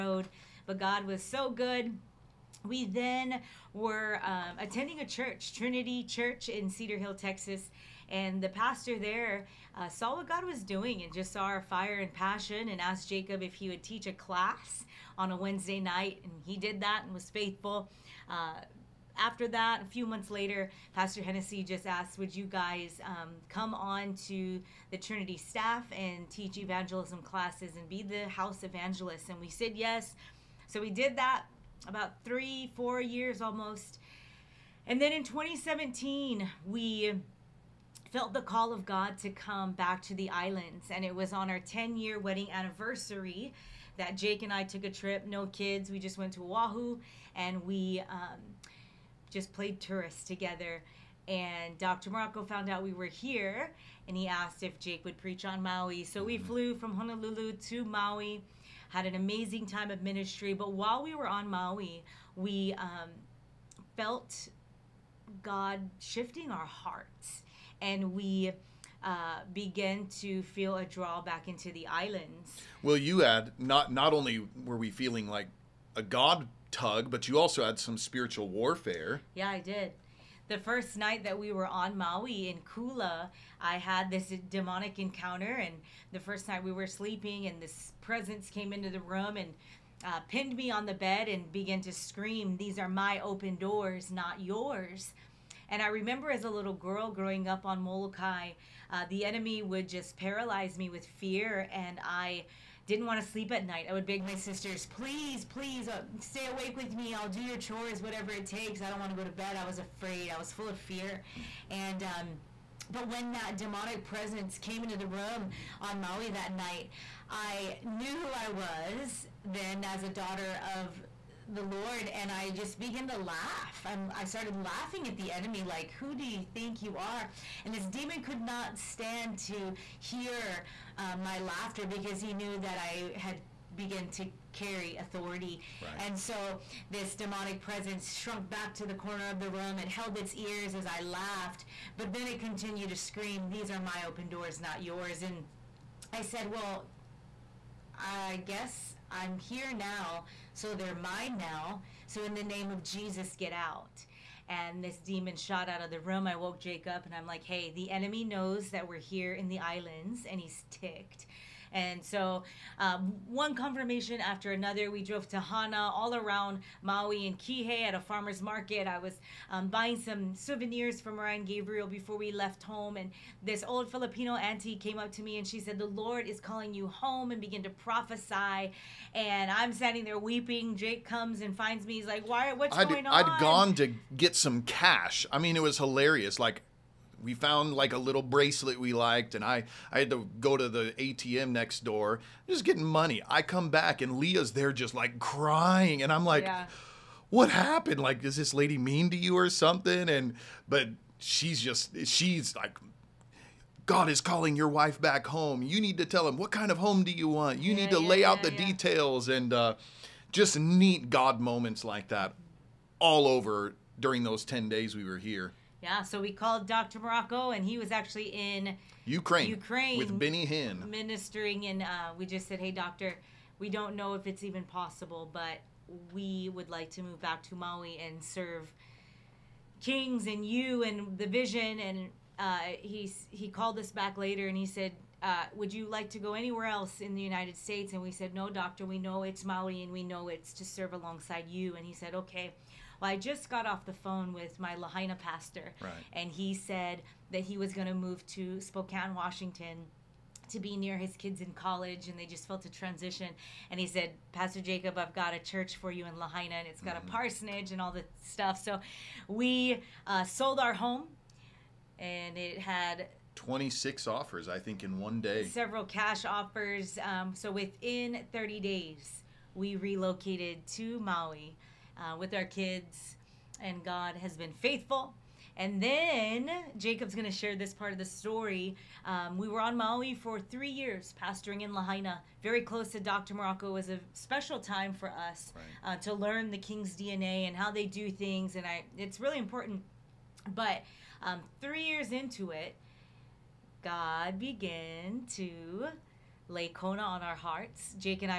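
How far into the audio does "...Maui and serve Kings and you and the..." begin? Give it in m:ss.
3:47.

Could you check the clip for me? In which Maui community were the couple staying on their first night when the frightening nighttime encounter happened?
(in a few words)
Kula.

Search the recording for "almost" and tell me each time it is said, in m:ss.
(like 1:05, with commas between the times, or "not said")
0:33.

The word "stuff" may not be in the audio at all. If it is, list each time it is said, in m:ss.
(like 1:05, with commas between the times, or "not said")
4:18.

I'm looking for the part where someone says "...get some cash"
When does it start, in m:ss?
3:04.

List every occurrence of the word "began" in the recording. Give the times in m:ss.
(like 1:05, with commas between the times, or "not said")
1:09, 1:31, 2:02, 2:57, 4:54.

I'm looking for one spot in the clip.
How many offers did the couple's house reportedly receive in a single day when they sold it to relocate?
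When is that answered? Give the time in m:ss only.
4:23.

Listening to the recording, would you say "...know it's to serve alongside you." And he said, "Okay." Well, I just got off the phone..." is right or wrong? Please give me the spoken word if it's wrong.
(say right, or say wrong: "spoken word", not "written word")
right.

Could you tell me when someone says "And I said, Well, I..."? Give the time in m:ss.
2:25.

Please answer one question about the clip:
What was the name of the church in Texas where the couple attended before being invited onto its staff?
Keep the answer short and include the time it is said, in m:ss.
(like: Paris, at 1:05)
Trinity Church, at 0:05.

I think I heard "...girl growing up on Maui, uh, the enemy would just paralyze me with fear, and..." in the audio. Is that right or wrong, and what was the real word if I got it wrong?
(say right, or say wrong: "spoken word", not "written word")
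wrong: "Molokai", not "Maui".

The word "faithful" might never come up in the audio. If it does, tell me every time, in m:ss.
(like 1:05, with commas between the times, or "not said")
0:17, 4:34.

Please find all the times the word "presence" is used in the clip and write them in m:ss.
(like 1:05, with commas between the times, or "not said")
1:28, 1:54, 2:17.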